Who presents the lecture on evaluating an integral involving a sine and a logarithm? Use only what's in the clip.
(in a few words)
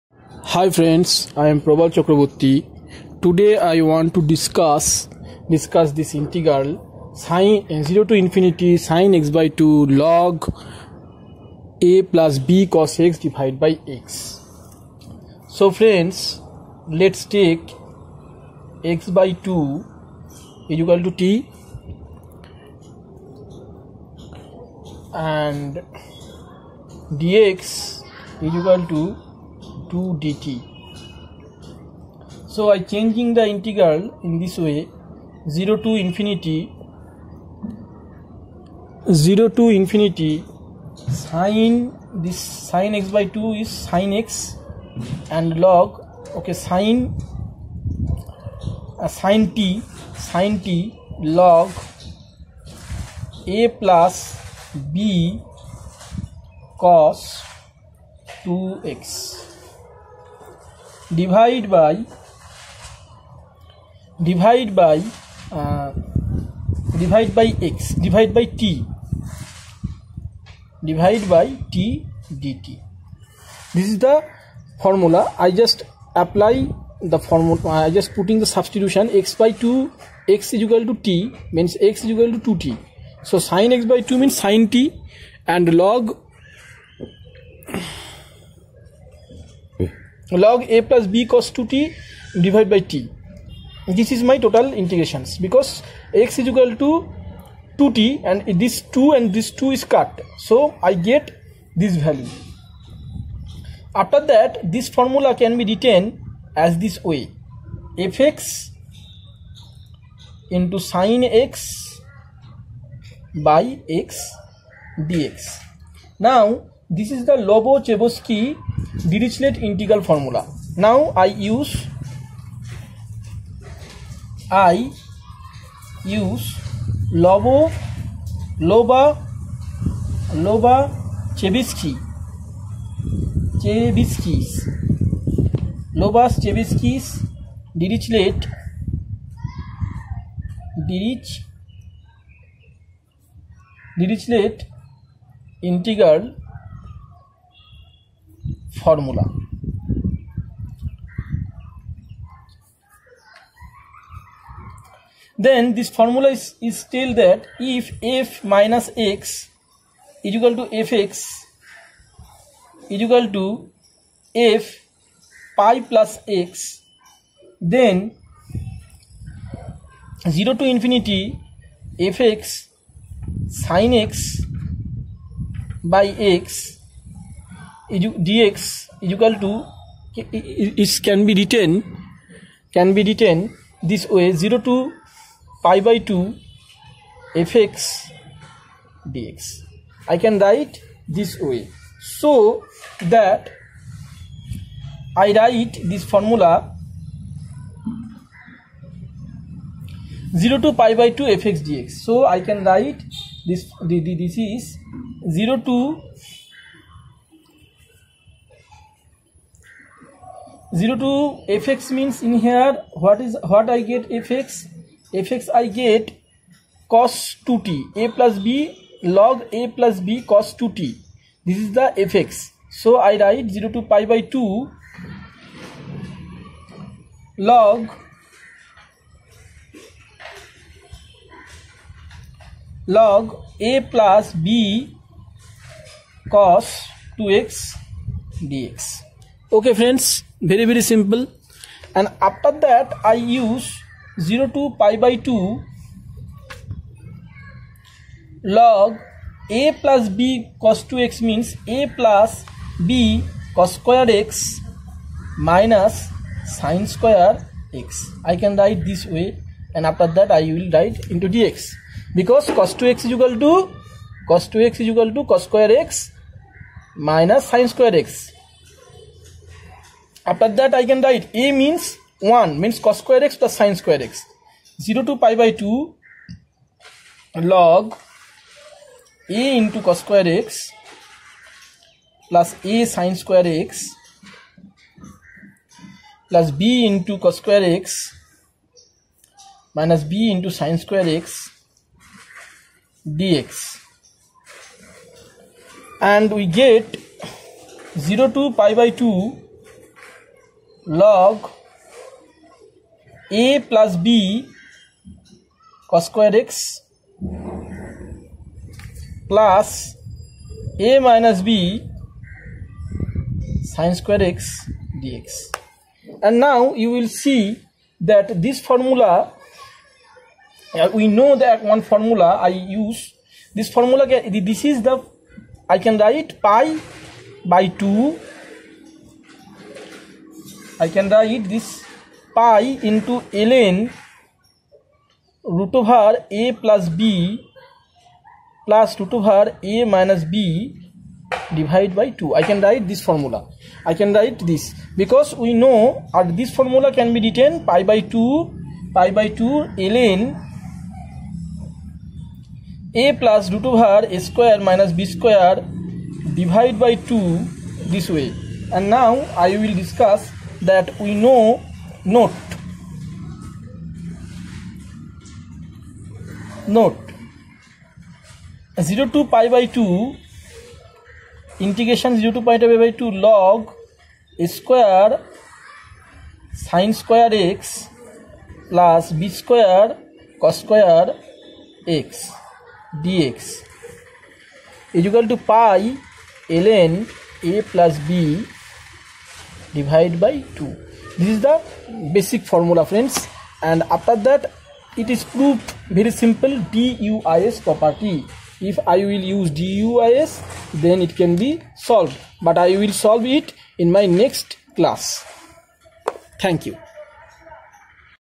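Prabal Chakraborty.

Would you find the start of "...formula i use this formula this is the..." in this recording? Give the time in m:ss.
5:21.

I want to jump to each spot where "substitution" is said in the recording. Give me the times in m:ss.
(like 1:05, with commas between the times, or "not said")
1:18.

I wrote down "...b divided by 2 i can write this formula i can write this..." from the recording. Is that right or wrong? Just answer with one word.
right.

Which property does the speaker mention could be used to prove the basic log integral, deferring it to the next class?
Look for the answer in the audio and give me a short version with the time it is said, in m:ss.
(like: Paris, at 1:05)
DUIS property, at 6:36.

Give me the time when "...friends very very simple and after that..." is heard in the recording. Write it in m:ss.
3:59.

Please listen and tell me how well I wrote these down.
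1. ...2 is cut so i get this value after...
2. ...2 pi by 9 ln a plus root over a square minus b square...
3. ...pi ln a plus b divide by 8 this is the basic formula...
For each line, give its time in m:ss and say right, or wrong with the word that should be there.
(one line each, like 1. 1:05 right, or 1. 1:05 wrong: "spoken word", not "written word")
1. 1:39 right
2. 5:48 wrong: "2", not "9"
3. 6:25 wrong: "2", not "8".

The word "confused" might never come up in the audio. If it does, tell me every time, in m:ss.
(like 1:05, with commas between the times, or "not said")
not said.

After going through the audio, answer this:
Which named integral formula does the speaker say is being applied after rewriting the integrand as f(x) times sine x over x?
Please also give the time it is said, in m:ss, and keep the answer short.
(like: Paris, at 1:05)
Lobachevsky Dirichlet integral formula, at 1:57.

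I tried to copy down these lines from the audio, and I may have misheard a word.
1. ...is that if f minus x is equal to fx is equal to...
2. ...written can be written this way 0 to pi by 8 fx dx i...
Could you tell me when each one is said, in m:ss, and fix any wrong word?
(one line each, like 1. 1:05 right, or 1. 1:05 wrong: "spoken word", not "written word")
1. 2:36 right
2. 3:01 wrong: "2", not "8".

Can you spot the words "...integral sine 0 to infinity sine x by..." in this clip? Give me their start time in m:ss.
0:06.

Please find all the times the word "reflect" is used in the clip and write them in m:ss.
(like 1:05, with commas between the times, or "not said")
not said.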